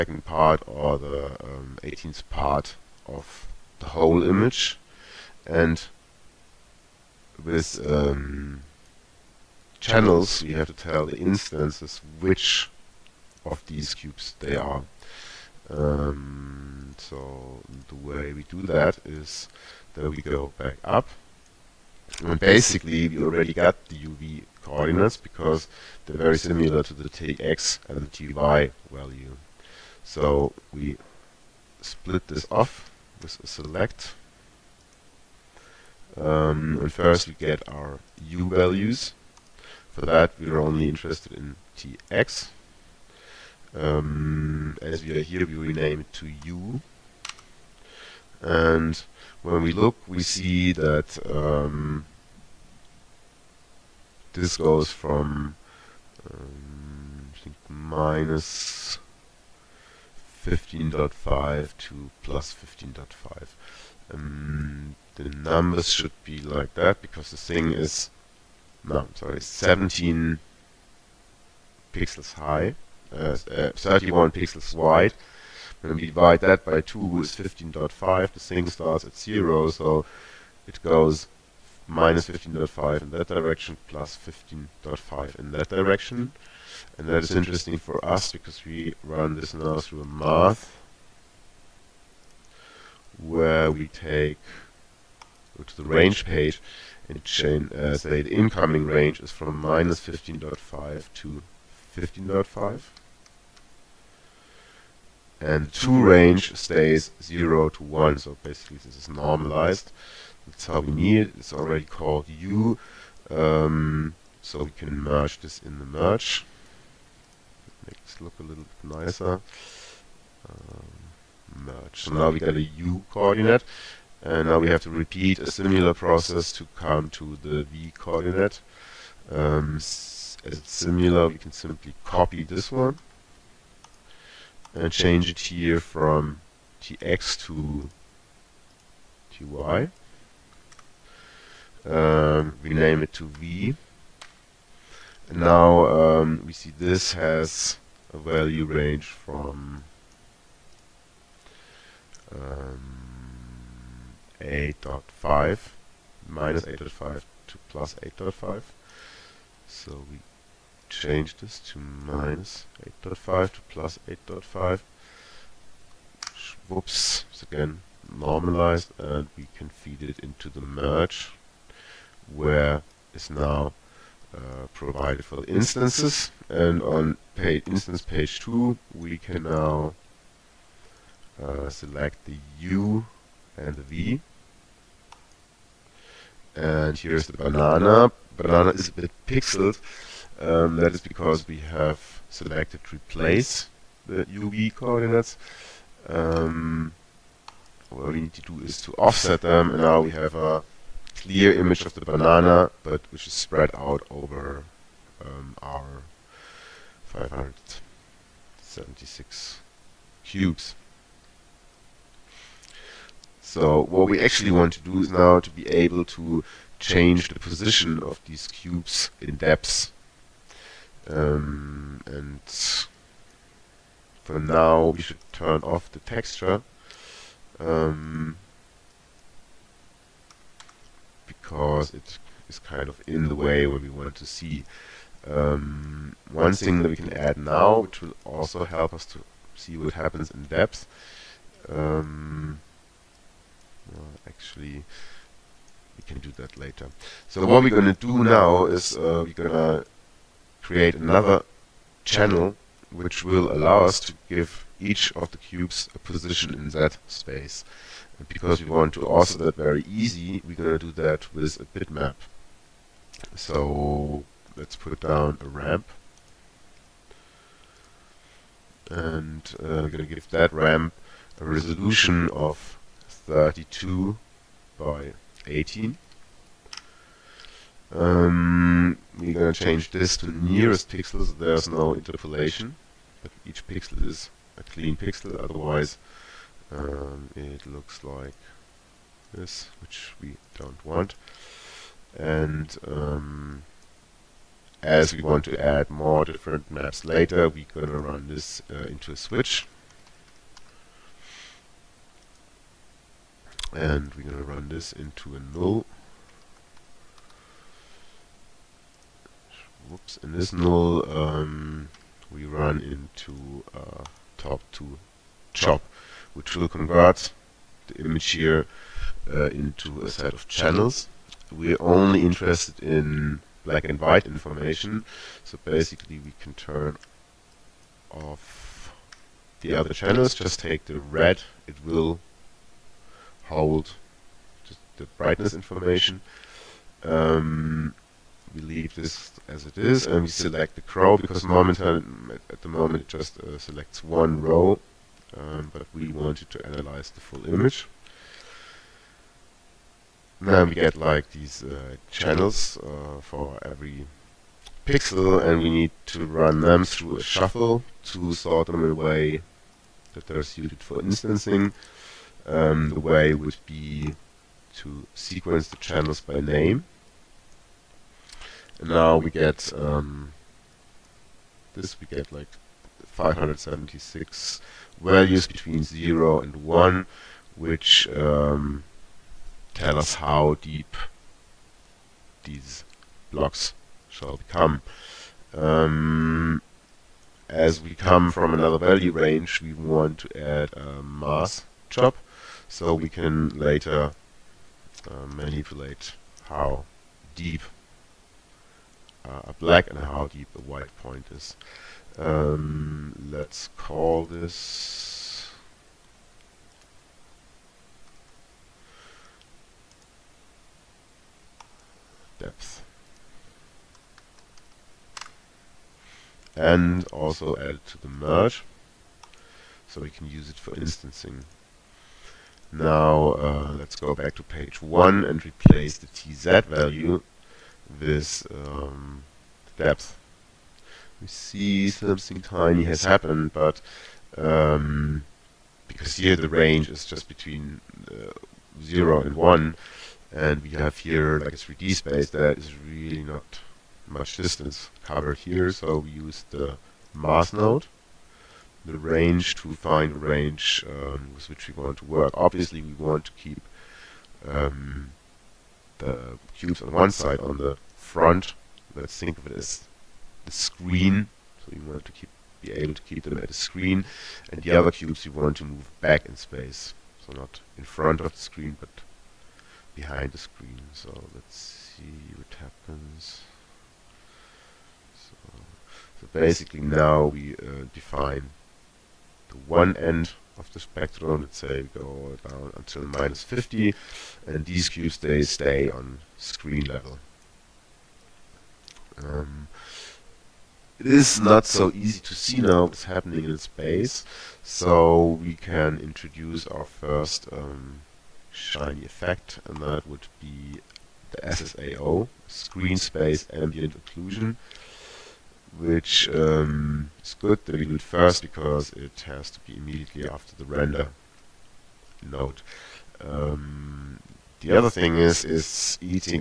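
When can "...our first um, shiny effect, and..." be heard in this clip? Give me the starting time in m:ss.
8:16.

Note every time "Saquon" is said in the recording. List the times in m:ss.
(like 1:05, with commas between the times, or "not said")
not said.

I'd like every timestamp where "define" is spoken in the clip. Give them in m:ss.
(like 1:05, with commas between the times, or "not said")
7:57.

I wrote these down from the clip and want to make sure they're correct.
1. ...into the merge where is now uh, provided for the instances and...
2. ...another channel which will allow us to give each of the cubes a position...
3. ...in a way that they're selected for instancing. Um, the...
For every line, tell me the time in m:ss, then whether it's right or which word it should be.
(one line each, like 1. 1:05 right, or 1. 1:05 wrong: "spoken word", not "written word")
1. 2:50 right
2. 4:10 right
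3. 5:58 wrong: "suited", not "selected".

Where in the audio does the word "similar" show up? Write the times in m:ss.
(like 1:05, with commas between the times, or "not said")
0:26, 2:05, 2:10.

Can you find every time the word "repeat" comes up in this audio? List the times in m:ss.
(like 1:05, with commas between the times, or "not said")
2:04.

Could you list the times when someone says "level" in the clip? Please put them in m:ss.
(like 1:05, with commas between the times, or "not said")
8:06.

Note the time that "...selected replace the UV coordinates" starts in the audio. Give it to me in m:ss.
3:12.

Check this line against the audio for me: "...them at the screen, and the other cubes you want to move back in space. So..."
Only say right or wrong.
right.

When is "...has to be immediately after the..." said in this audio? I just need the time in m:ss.
8:29.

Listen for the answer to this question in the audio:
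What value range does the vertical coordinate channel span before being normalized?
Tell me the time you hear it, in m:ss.
2:34.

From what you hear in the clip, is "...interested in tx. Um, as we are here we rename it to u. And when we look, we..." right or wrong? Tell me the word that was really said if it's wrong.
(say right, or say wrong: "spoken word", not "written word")
right.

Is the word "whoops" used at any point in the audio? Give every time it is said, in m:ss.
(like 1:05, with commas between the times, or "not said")
2:46, 5:09.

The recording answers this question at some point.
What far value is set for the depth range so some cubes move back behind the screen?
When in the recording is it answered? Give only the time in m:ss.
8:03.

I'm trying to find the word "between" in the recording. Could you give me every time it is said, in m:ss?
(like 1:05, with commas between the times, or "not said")
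6:15, 7:17.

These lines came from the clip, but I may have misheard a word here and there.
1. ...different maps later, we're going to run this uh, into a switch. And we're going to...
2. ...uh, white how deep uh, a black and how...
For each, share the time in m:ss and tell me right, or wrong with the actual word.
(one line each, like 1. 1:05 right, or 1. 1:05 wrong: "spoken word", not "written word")
1. 4:56 right
2. 6:35 wrong: "manipulate", not "white".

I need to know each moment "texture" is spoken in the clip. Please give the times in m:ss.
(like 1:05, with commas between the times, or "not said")
3:45.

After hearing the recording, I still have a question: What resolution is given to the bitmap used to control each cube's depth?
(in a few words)
32 by 18.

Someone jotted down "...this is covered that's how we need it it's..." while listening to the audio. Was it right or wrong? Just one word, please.
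wrong.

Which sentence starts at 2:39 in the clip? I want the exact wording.
So we change this to minus 8.5 to plus 8.5.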